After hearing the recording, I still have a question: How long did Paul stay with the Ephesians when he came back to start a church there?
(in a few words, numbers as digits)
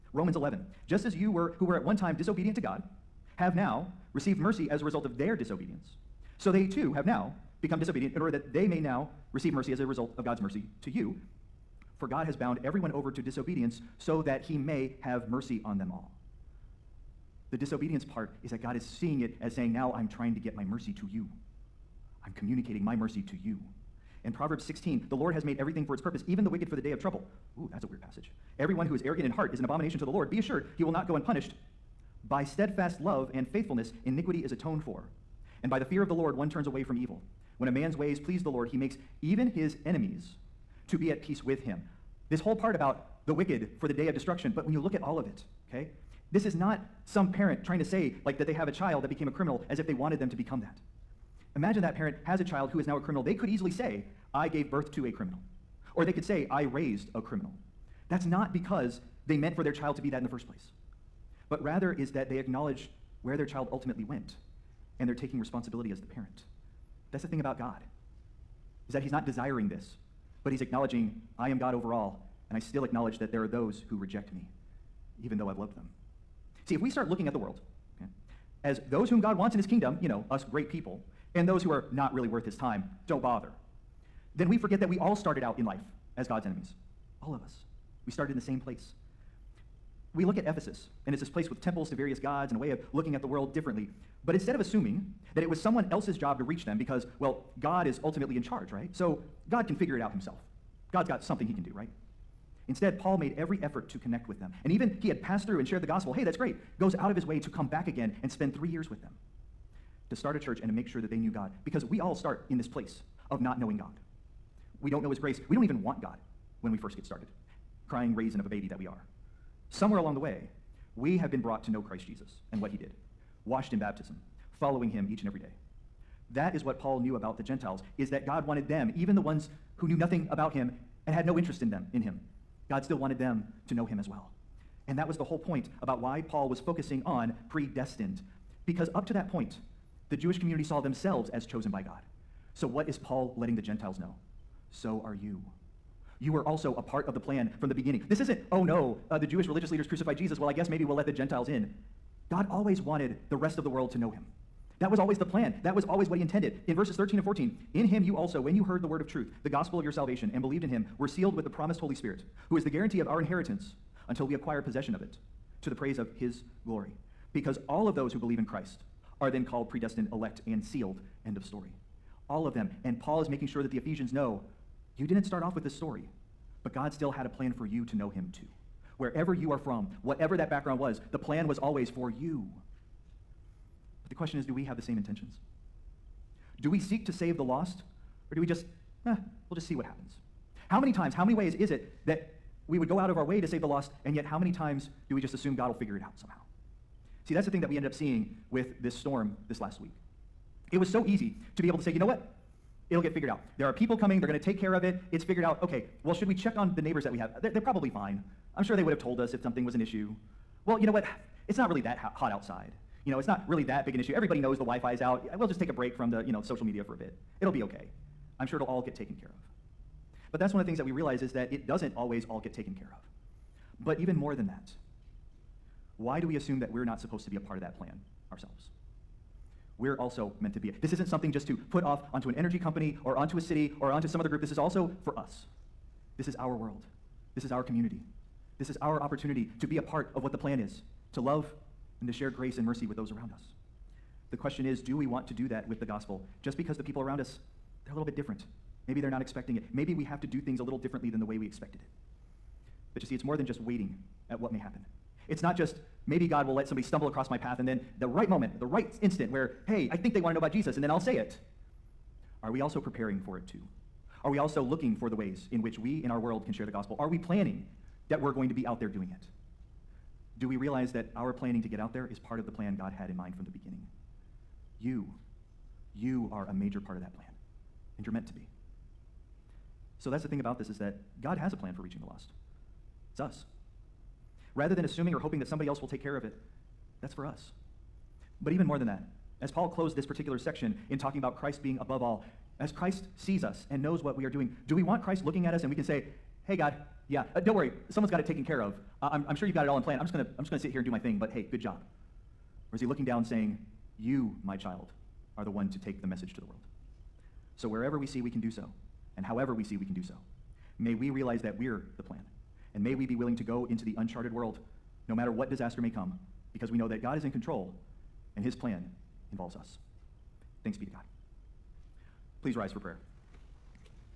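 3 years.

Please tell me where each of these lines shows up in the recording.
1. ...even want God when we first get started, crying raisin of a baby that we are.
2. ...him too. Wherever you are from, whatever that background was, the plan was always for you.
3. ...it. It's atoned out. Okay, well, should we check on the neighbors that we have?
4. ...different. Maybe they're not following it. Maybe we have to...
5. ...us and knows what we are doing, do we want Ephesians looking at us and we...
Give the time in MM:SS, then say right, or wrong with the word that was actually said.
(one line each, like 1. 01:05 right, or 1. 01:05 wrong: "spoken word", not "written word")
1. 01:55 right
2. 02:58 right
3. 03:24 wrong: "figured", not "atoned"
4. 04:08 wrong: "expecting", not "following"
5. 04:53 wrong: "Christ", not "Ephesians".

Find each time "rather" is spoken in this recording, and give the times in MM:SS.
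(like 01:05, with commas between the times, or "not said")
01:01, 04:44.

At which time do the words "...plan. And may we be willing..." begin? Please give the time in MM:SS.
05:12.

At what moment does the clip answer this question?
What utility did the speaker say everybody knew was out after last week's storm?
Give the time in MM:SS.
03:34.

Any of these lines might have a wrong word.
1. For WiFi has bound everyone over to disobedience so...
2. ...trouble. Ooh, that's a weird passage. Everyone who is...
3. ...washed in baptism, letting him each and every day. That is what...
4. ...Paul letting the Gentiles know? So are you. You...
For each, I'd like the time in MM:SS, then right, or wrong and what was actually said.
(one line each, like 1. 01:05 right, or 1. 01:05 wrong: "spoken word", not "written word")
1. 00:11 wrong: "God", not "WiFi"
2. 00:26 right
3. 02:03 wrong: "following", not "letting"
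4. 02:23 right.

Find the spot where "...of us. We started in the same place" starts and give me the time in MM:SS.
01:27.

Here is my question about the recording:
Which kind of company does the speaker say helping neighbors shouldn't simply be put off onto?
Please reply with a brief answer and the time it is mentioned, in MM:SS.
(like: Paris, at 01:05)
energy company, at 03:52.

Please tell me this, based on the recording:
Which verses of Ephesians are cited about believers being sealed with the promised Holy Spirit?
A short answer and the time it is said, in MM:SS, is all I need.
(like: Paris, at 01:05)
13 and 14, at 02:36.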